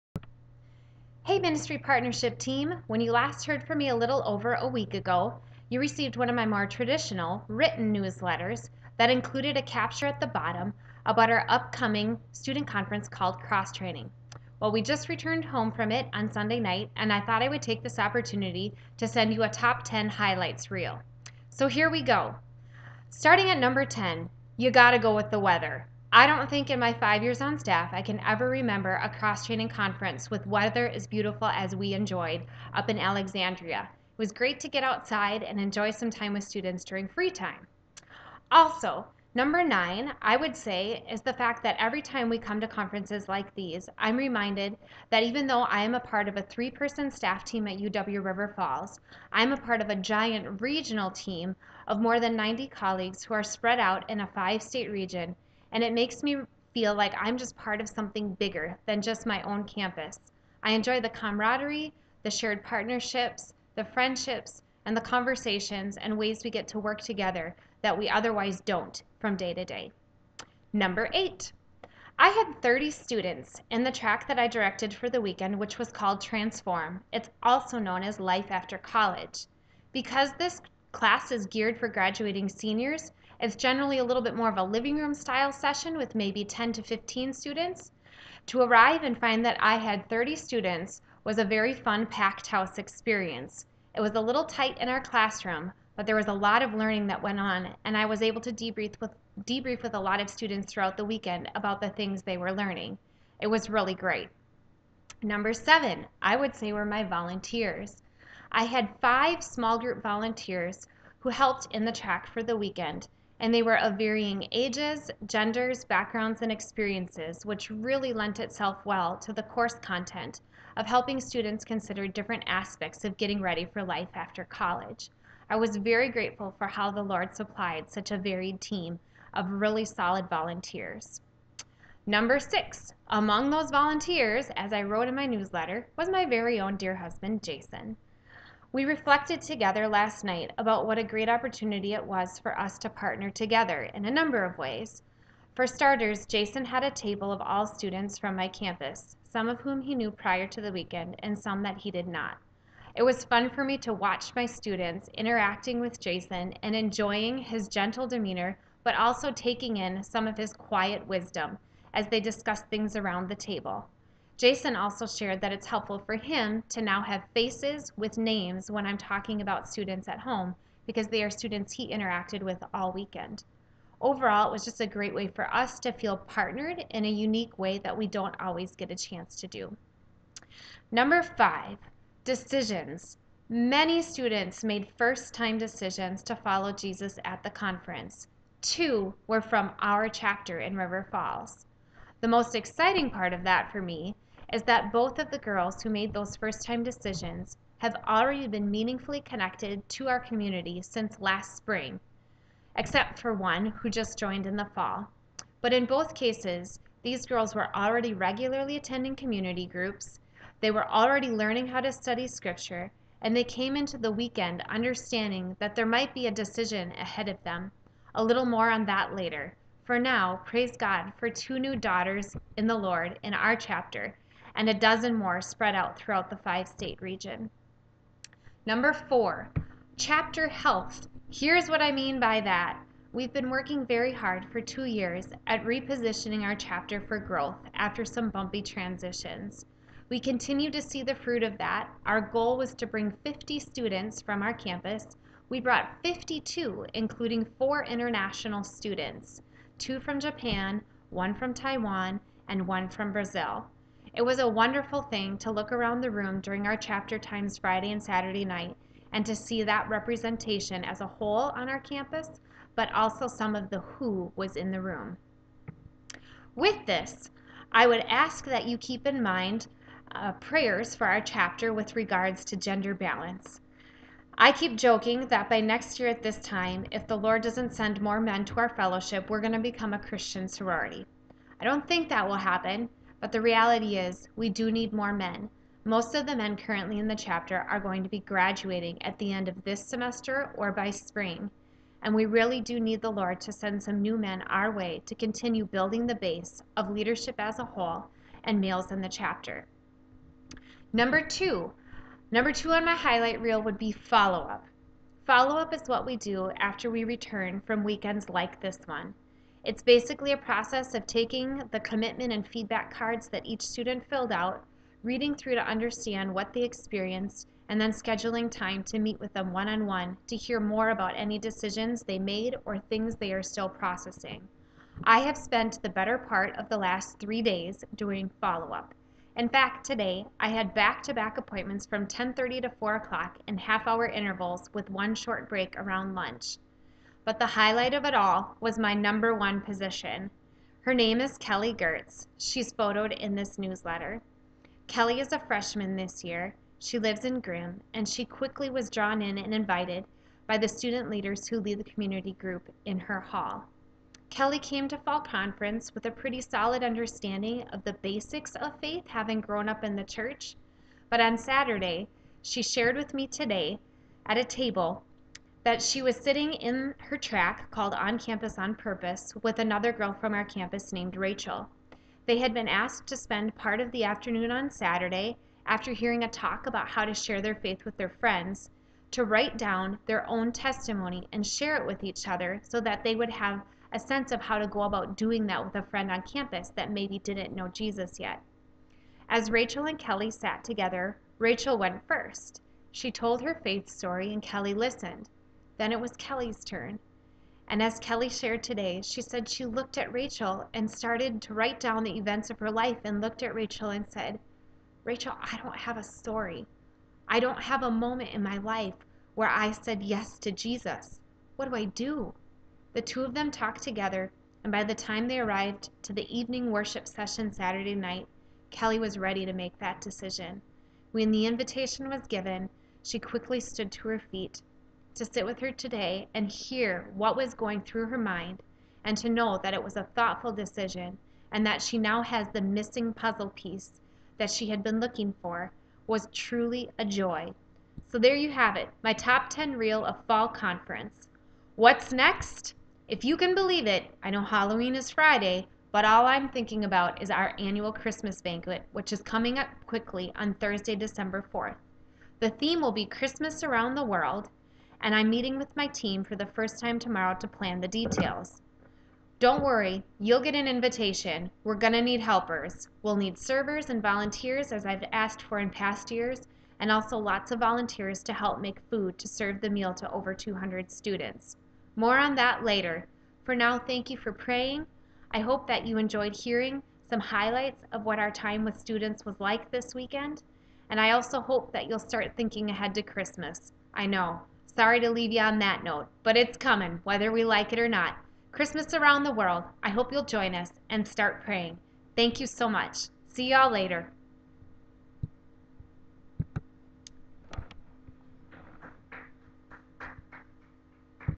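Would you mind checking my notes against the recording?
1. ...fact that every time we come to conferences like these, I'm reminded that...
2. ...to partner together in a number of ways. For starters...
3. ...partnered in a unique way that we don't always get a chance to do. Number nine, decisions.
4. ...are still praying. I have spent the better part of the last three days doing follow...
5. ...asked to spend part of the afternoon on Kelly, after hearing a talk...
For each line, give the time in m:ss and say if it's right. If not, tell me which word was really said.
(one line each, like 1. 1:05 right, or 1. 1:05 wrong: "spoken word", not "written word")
1. 0:41 right
2. 2:22 right
3. 2:56 wrong: "five", not "nine"
4. 5:23 wrong: "processing", not "praying"
5. 6:12 wrong: "Saturday", not "Kelly".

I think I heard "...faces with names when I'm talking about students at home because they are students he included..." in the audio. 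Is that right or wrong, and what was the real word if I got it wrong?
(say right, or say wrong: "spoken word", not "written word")
wrong: "interacted", not "included".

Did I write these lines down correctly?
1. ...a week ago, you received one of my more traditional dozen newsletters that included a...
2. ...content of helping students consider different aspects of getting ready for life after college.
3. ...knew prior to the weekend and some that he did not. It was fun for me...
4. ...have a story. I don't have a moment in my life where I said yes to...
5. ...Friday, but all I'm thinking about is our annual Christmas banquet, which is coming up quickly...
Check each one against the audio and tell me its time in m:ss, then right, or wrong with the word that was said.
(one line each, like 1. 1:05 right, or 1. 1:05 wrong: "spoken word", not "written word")
1. 0:04 wrong: "written", not "dozen"
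2. 1:59 right
3. 2:29 right
4. 6:45 right
5. 7:25 right.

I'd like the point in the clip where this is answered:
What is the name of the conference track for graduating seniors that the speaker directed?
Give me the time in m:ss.
1:16.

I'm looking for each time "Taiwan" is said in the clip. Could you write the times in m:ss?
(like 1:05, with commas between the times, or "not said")
4:11.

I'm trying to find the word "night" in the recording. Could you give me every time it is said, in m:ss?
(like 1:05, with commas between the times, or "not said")
0:16, 2:20, 4:18, 6:57.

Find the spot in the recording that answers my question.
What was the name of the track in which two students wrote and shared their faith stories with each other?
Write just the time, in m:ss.
6:07.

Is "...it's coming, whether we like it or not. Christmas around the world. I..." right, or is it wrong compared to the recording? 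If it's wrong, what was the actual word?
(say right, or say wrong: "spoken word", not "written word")
right.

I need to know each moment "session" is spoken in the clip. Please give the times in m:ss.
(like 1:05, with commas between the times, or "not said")
1:25, 6:57.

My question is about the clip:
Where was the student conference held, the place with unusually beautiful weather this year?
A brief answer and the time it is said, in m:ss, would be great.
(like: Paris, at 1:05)
Alexandria, at 0:32.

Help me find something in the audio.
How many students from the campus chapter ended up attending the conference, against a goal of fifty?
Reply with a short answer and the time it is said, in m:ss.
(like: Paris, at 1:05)
52, at 4:06.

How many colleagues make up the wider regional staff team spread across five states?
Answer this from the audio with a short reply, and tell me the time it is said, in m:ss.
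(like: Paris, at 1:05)
more than 90, at 0:52.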